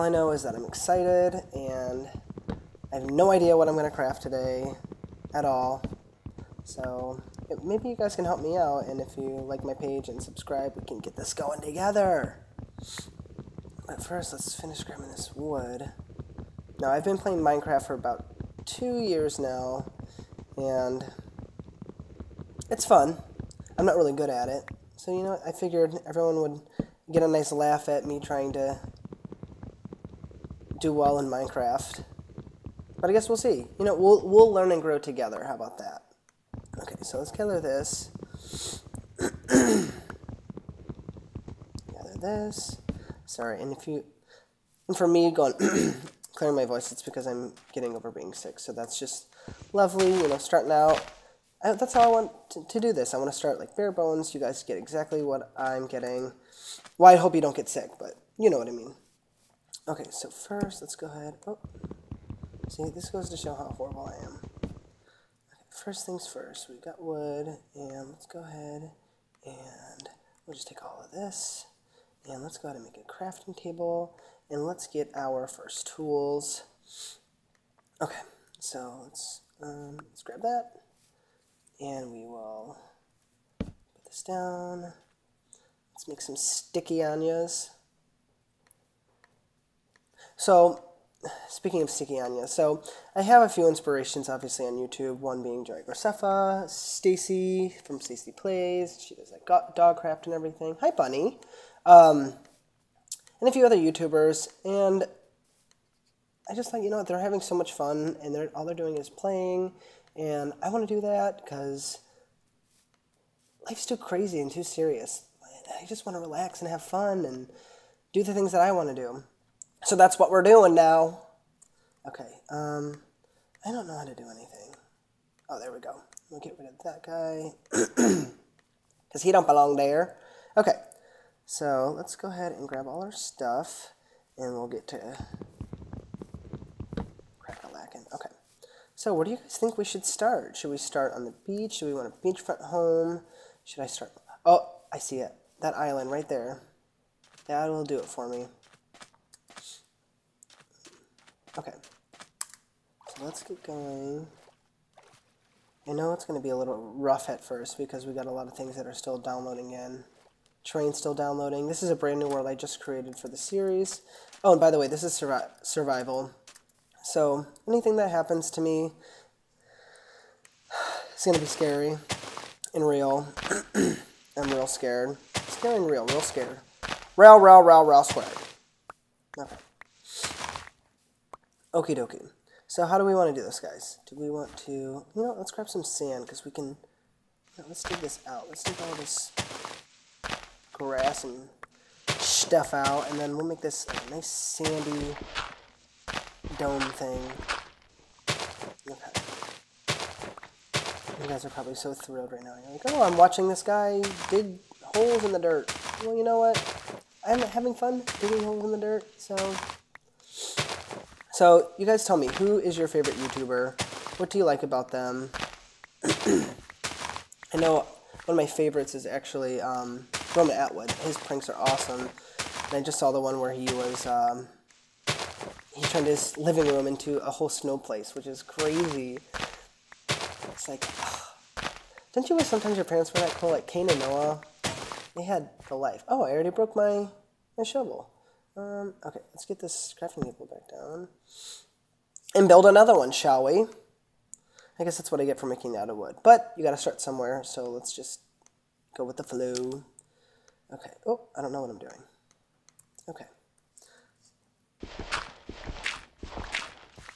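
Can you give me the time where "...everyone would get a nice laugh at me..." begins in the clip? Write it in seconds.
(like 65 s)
26 s.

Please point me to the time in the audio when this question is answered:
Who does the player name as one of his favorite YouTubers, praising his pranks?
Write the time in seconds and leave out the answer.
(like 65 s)
220 s.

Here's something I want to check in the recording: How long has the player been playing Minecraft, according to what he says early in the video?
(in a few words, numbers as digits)
2 years.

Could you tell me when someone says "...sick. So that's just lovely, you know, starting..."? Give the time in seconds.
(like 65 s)
48 s.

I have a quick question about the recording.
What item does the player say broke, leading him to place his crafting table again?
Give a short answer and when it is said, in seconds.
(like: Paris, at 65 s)
shovel, at 237 s.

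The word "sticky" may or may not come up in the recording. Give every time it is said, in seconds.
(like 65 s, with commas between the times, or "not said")
86 s, 91 s.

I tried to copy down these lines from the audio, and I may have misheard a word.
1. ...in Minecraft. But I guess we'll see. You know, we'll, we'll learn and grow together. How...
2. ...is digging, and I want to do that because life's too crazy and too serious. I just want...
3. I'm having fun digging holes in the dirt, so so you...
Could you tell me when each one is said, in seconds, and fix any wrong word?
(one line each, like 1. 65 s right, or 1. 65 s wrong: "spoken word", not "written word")
1. 31 s right
2. 108 s wrong: "playing", not "digging"
3. 207 s right.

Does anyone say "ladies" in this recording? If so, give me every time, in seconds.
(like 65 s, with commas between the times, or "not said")
not said.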